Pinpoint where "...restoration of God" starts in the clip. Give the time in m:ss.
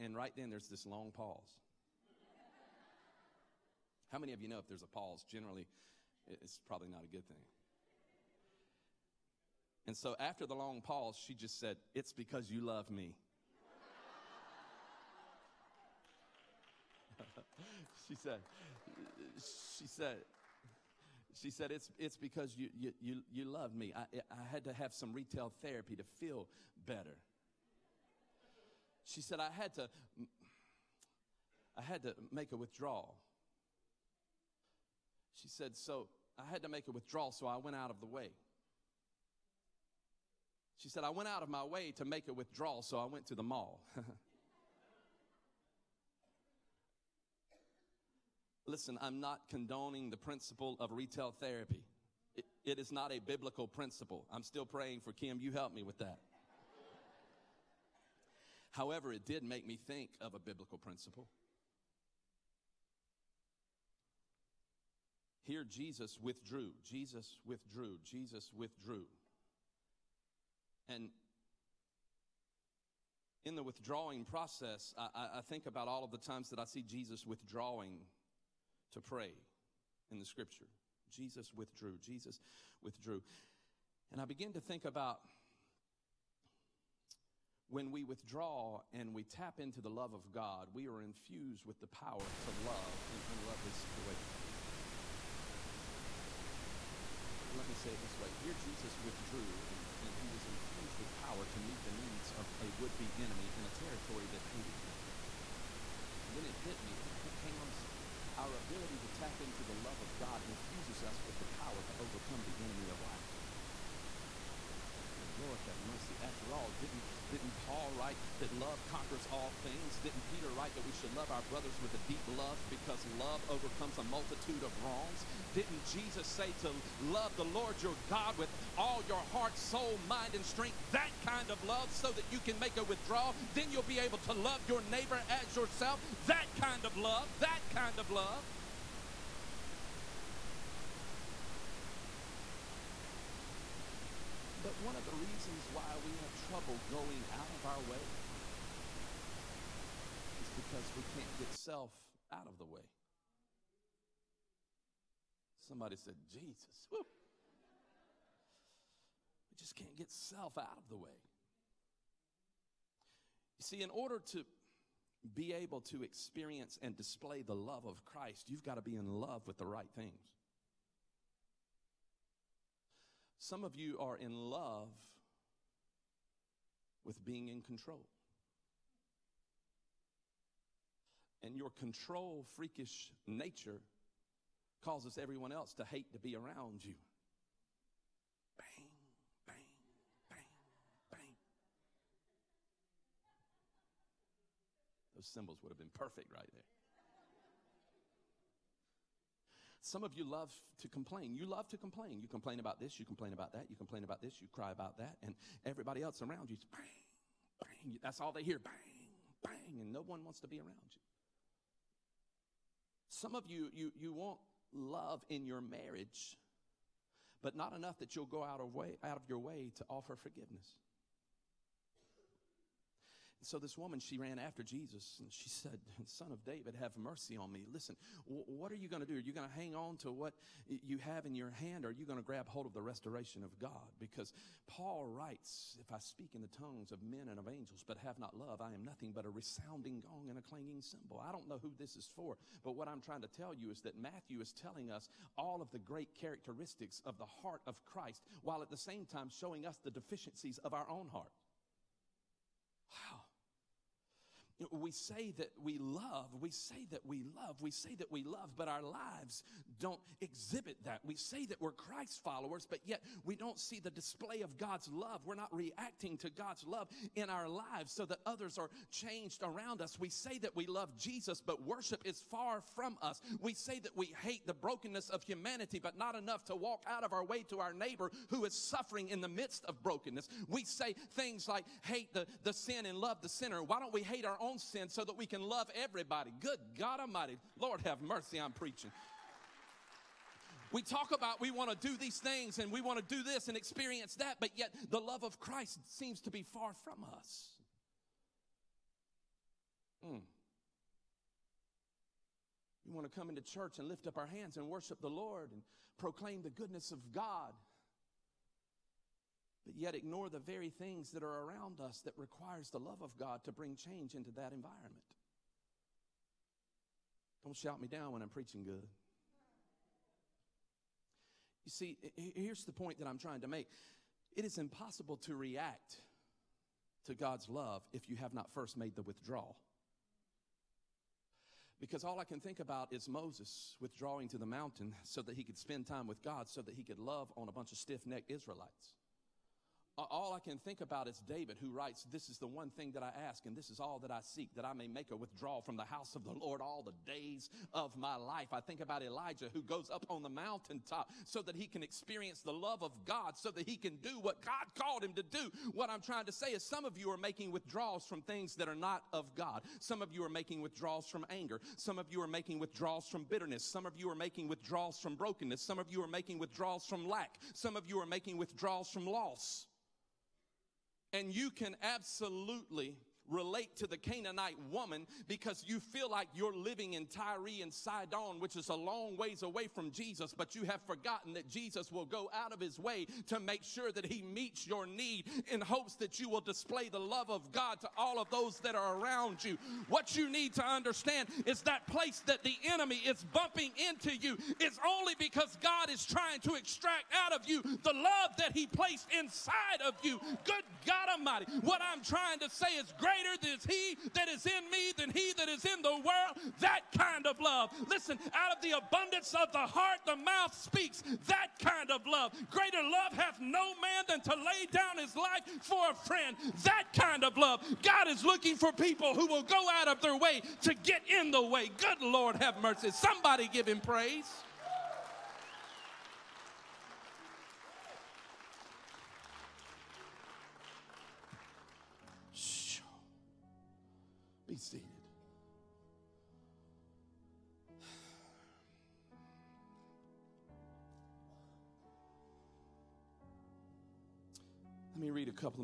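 3:52.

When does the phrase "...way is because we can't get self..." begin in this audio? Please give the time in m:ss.
2:27.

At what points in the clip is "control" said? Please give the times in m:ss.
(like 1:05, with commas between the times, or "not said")
2:57, 3:01.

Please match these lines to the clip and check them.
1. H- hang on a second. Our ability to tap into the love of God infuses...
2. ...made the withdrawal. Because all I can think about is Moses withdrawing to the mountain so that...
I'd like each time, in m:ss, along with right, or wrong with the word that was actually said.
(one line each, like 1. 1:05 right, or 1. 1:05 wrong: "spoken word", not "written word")
1. 1:47 right
2. 5:28 right.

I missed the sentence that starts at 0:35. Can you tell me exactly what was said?
She said, so I had to make a withdrawal, so I went out of the way.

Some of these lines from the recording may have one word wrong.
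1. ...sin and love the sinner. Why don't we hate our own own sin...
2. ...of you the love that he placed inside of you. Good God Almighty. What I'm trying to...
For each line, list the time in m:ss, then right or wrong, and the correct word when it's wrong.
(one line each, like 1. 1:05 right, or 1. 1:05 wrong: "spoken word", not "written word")
1. 4:42 right
2. 6:37 right.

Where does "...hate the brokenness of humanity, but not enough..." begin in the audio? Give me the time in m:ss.
4:34.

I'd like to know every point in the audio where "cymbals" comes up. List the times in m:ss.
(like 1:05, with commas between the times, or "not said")
3:15, 4:00.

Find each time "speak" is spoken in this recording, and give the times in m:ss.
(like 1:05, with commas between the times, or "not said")
3:55, 6:50.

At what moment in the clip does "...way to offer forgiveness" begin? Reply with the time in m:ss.
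3:39.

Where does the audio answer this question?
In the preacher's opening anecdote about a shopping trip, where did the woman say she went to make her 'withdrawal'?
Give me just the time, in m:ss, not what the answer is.
0:43.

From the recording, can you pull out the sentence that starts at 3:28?
That's all they hear bang, bang, and no one wants to be around you.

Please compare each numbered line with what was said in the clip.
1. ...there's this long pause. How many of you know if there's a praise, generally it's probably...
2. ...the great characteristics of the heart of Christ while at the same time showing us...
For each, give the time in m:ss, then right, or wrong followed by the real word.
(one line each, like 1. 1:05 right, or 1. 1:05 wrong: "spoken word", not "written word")
1. 0:00 wrong: "pause", not "praise"
2. 4:05 right.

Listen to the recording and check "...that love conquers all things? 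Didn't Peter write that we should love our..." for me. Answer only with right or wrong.
right.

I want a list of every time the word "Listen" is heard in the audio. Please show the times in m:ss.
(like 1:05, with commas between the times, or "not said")
0:48, 3:47, 6:47.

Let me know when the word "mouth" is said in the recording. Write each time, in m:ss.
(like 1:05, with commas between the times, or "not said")
6:50.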